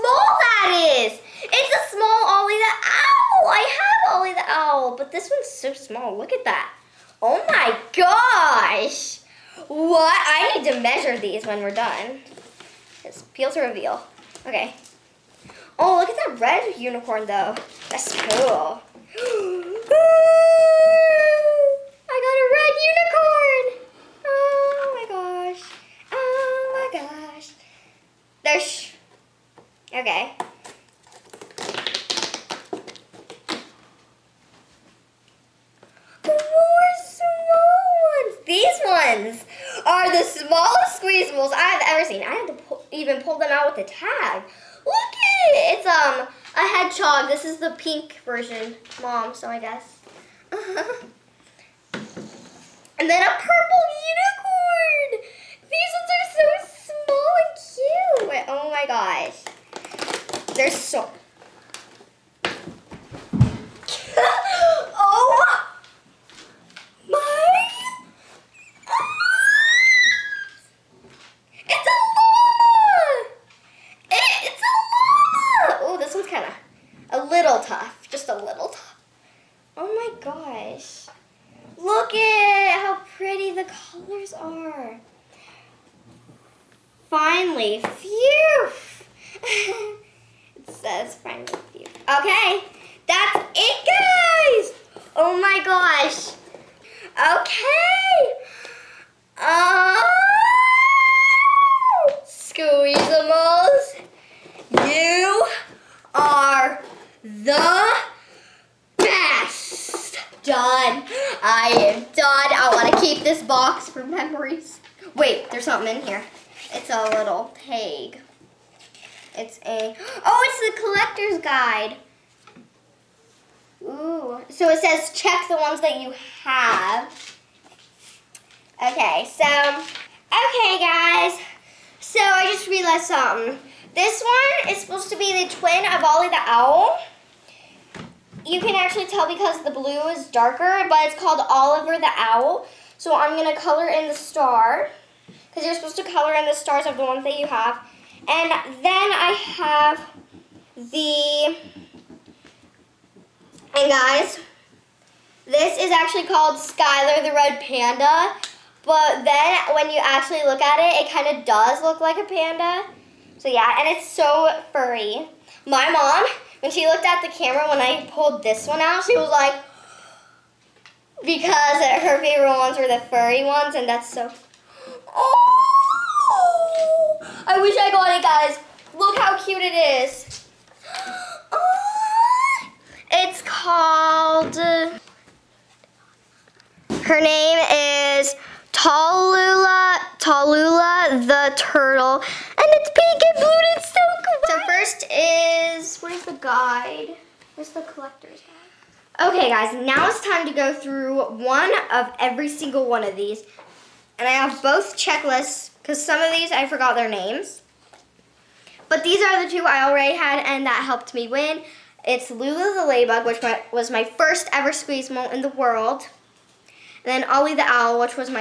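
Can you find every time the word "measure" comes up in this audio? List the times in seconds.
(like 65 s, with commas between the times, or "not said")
10 s.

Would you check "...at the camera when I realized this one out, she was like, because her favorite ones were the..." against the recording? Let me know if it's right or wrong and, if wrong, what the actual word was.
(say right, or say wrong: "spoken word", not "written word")
wrong: "pulled", not "realized".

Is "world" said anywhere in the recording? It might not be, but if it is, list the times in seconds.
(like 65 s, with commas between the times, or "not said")
215 s.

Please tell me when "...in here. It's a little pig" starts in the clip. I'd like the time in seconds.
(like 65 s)
115 s.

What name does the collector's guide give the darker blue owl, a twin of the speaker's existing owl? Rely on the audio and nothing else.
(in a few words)
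Oliver the Owl.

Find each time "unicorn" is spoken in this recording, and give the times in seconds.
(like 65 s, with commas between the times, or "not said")
16 s, 23 s, 54 s.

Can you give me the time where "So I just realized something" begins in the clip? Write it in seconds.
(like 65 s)
131 s.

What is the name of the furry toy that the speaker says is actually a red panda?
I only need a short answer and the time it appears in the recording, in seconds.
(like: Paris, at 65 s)
Skylar, at 156 s.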